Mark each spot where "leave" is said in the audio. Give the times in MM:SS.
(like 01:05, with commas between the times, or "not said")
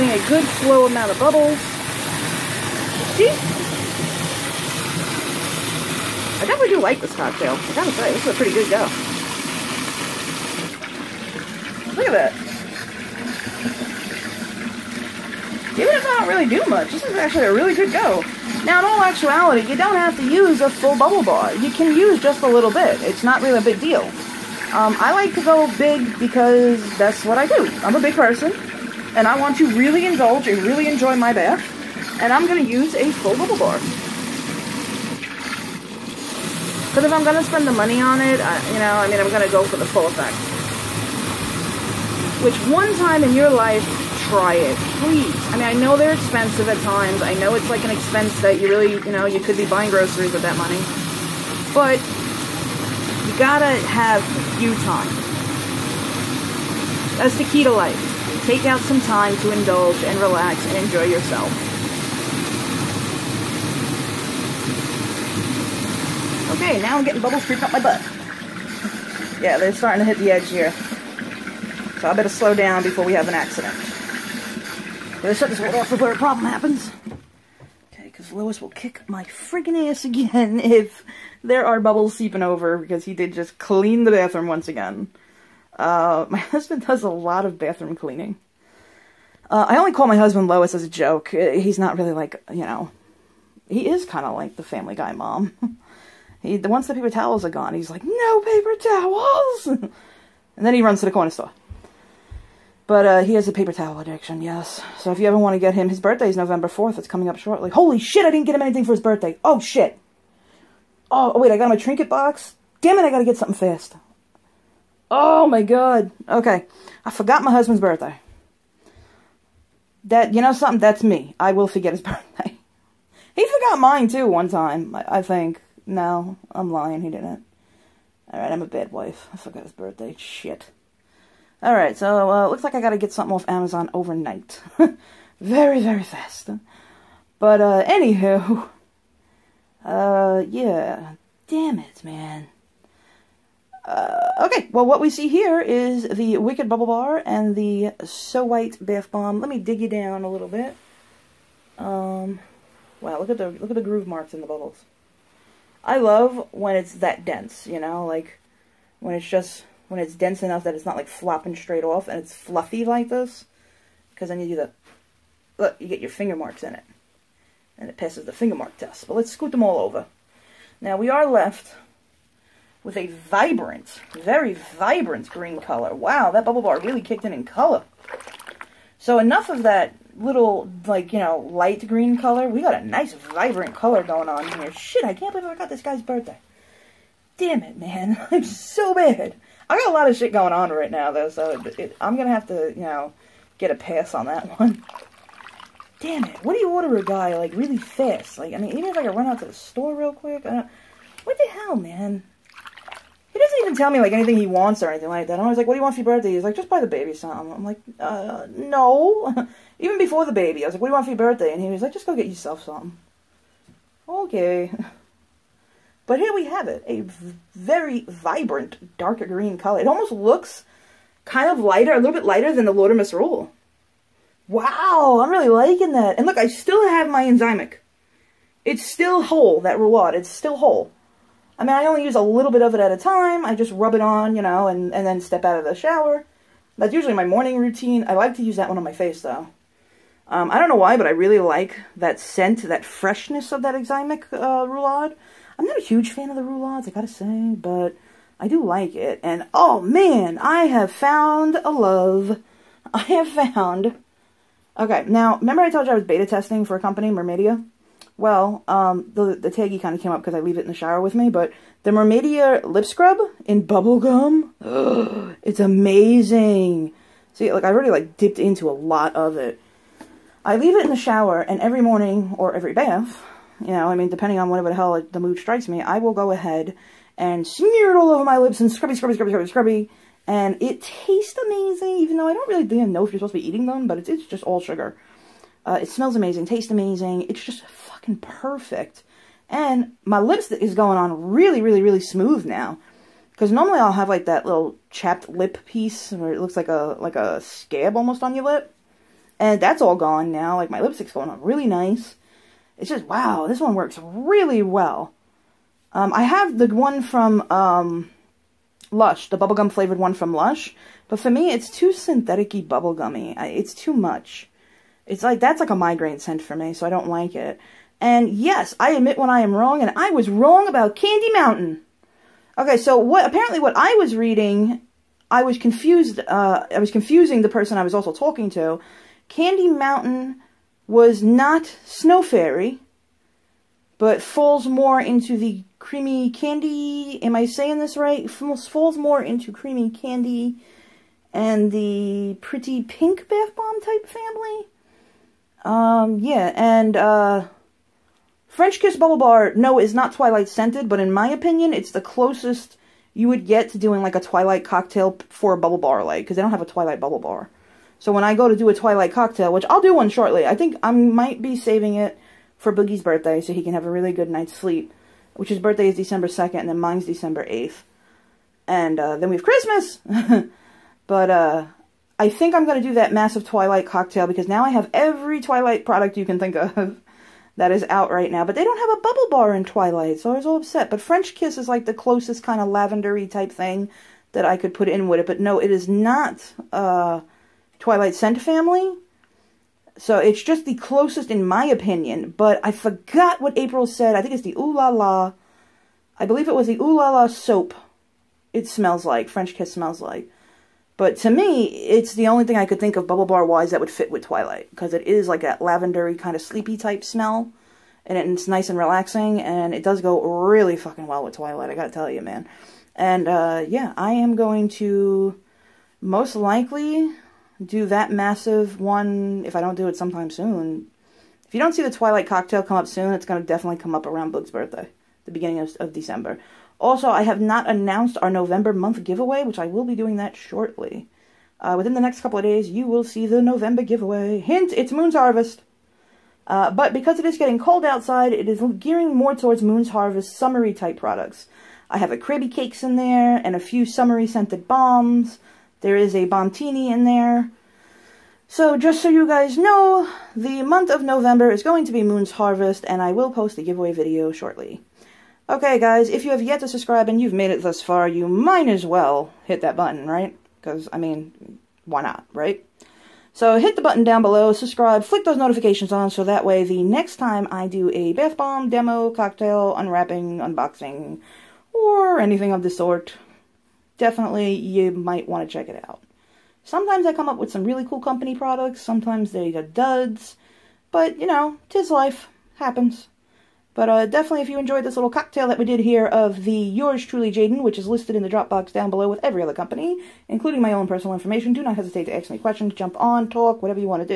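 04:20, 04:30.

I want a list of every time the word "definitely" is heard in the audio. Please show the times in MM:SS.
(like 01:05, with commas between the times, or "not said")
00:06, 07:03, 07:53, 08:04.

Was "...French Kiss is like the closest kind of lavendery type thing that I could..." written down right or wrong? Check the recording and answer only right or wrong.
right.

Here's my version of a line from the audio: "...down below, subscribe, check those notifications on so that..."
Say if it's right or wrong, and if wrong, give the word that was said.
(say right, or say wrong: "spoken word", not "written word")
wrong: "flick", not "check".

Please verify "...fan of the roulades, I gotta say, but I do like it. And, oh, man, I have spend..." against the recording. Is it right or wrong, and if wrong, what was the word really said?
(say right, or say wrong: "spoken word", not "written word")
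wrong: "found", not "spend".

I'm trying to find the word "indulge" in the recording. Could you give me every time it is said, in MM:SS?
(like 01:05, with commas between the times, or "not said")
00:30, 00:59.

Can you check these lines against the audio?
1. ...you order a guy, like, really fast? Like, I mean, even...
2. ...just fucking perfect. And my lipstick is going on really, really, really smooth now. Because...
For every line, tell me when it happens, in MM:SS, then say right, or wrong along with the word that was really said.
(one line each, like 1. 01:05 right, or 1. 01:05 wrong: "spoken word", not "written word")
1. 03:16 right
2. 04:47 right.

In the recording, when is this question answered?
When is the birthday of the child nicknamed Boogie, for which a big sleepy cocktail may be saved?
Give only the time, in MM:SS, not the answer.
06:05.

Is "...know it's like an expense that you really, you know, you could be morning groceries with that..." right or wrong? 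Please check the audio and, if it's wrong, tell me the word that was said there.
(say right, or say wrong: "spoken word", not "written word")
wrong: "buying", not "morning".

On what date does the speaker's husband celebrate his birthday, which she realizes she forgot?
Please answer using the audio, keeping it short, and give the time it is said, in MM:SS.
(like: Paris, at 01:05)
November 4th, at 01:46.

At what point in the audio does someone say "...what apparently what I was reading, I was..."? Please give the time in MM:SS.
05:22.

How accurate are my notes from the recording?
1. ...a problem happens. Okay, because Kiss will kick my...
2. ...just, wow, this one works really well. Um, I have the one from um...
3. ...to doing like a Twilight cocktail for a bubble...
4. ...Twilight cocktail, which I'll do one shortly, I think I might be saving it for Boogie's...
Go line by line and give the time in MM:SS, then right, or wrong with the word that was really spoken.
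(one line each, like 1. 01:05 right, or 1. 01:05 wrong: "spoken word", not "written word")
1. 01:16 wrong: "Lois", not "Kiss"
2. 05:02 right
3. 05:53 right
4. 05:58 right.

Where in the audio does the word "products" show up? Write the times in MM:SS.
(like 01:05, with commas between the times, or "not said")
06:15, 07:20, 07:58.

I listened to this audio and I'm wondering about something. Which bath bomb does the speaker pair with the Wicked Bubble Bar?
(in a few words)
So White.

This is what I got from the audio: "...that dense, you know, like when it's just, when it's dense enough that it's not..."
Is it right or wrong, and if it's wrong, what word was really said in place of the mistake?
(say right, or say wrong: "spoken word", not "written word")
right.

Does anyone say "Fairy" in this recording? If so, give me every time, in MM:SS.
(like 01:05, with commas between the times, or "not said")
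05:32.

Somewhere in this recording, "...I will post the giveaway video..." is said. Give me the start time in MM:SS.
07:33.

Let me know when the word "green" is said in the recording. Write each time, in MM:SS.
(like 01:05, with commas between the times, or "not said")
02:55, 03:01, 03:39.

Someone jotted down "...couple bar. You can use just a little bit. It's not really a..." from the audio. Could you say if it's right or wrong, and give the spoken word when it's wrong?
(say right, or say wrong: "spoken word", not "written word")
wrong: "bubble", not "couple".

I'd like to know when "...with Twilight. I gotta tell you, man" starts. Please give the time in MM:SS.
06:51.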